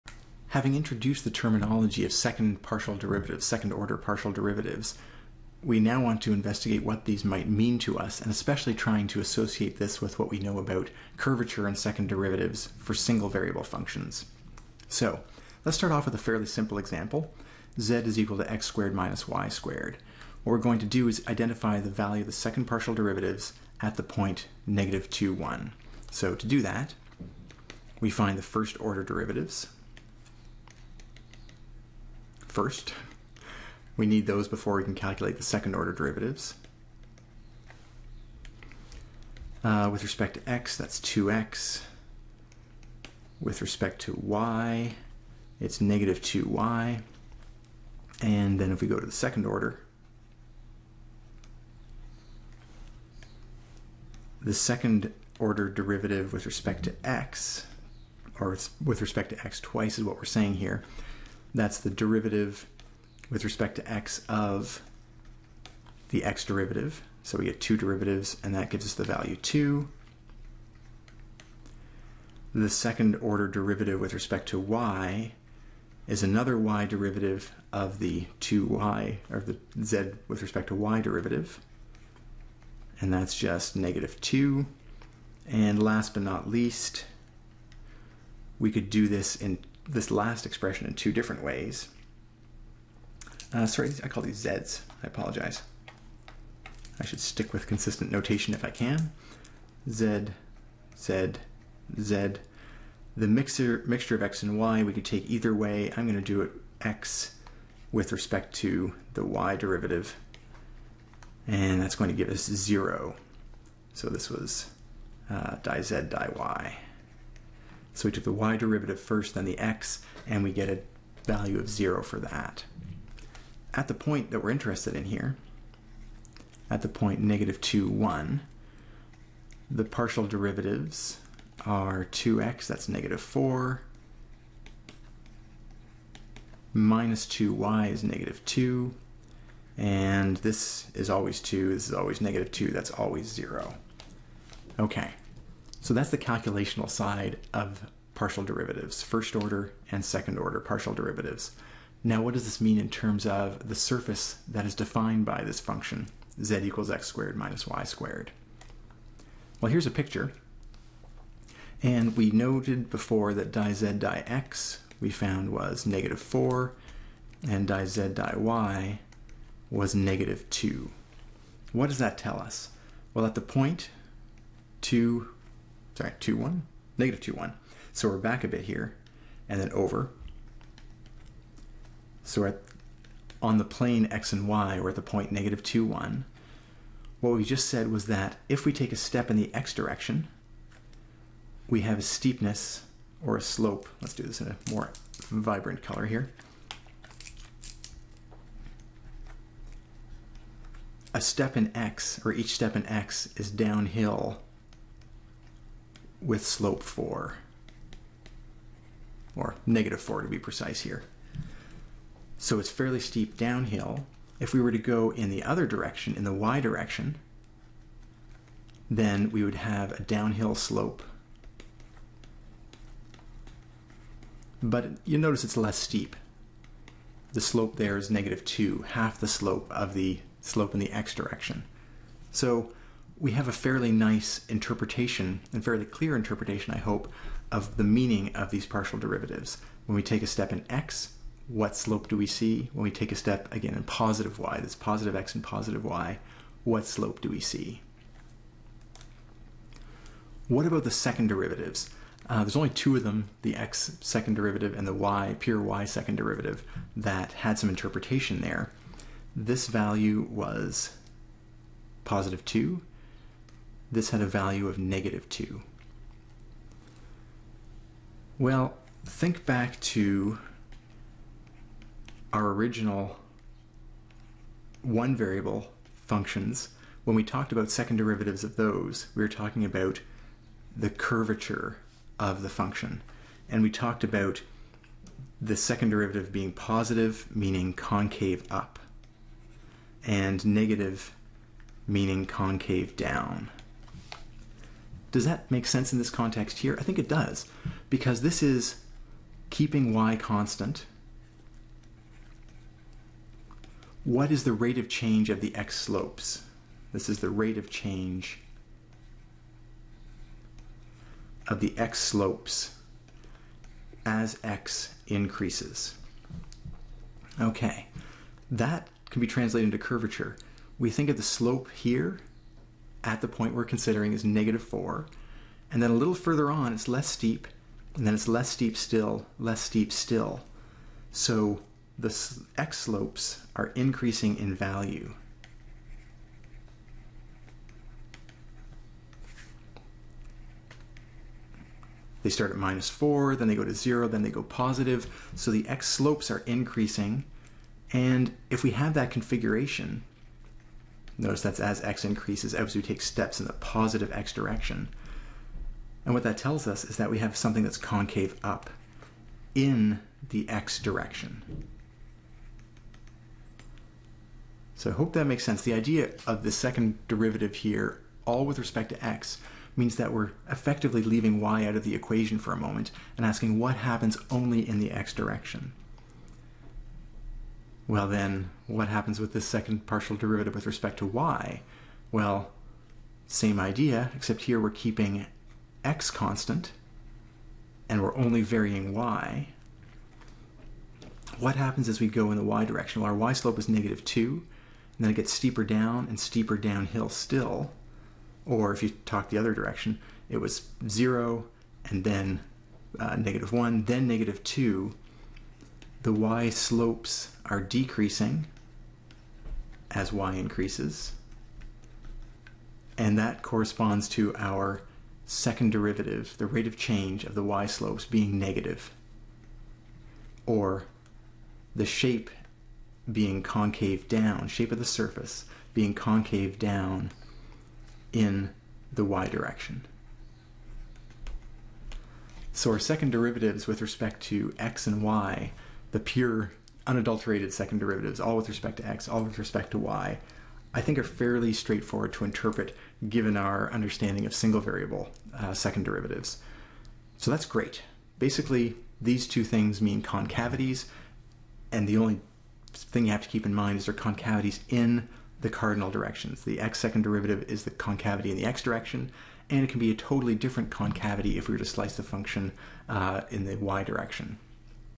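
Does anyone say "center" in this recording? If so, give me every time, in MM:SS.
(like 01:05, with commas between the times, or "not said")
not said.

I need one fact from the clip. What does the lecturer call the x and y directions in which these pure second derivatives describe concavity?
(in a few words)
Cardinal directions.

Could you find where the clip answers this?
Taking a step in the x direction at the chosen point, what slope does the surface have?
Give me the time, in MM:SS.
03:29.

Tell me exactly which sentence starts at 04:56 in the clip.
I think it does, because this is keeping y constant.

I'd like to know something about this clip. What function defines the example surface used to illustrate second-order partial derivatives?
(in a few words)
z = x^2 - y^2.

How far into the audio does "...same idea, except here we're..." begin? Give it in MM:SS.
06:23.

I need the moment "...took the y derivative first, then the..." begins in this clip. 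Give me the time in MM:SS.
01:58.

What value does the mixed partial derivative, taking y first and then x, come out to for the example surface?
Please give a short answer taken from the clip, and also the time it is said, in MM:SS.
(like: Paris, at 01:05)
0, at 01:52.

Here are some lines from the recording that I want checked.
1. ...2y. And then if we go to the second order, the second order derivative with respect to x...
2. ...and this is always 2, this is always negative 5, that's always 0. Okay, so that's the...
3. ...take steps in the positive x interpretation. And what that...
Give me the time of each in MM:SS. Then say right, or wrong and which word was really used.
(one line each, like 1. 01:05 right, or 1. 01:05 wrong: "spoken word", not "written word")
1. 00:46 right
2. 02:19 wrong: "2", not "5"
3. 05:52 wrong: "direction", not "interpretation".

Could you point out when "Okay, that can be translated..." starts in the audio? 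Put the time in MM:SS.
05:17.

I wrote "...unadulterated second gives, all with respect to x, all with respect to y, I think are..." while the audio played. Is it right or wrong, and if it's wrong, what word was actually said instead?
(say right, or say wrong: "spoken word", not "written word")
wrong: "derivatives", not "gives".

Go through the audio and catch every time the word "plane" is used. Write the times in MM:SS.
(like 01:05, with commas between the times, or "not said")
03:03.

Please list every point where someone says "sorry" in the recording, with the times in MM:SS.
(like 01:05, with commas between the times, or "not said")
01:33, 02:55.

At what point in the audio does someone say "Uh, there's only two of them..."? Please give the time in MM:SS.
04:12.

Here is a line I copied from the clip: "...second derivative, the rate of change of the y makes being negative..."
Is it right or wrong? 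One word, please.
wrong.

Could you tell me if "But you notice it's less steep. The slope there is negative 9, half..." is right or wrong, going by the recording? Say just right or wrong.
wrong.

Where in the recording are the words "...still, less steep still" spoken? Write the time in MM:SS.
05:28.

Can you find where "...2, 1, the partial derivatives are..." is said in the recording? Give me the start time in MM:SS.
02:07.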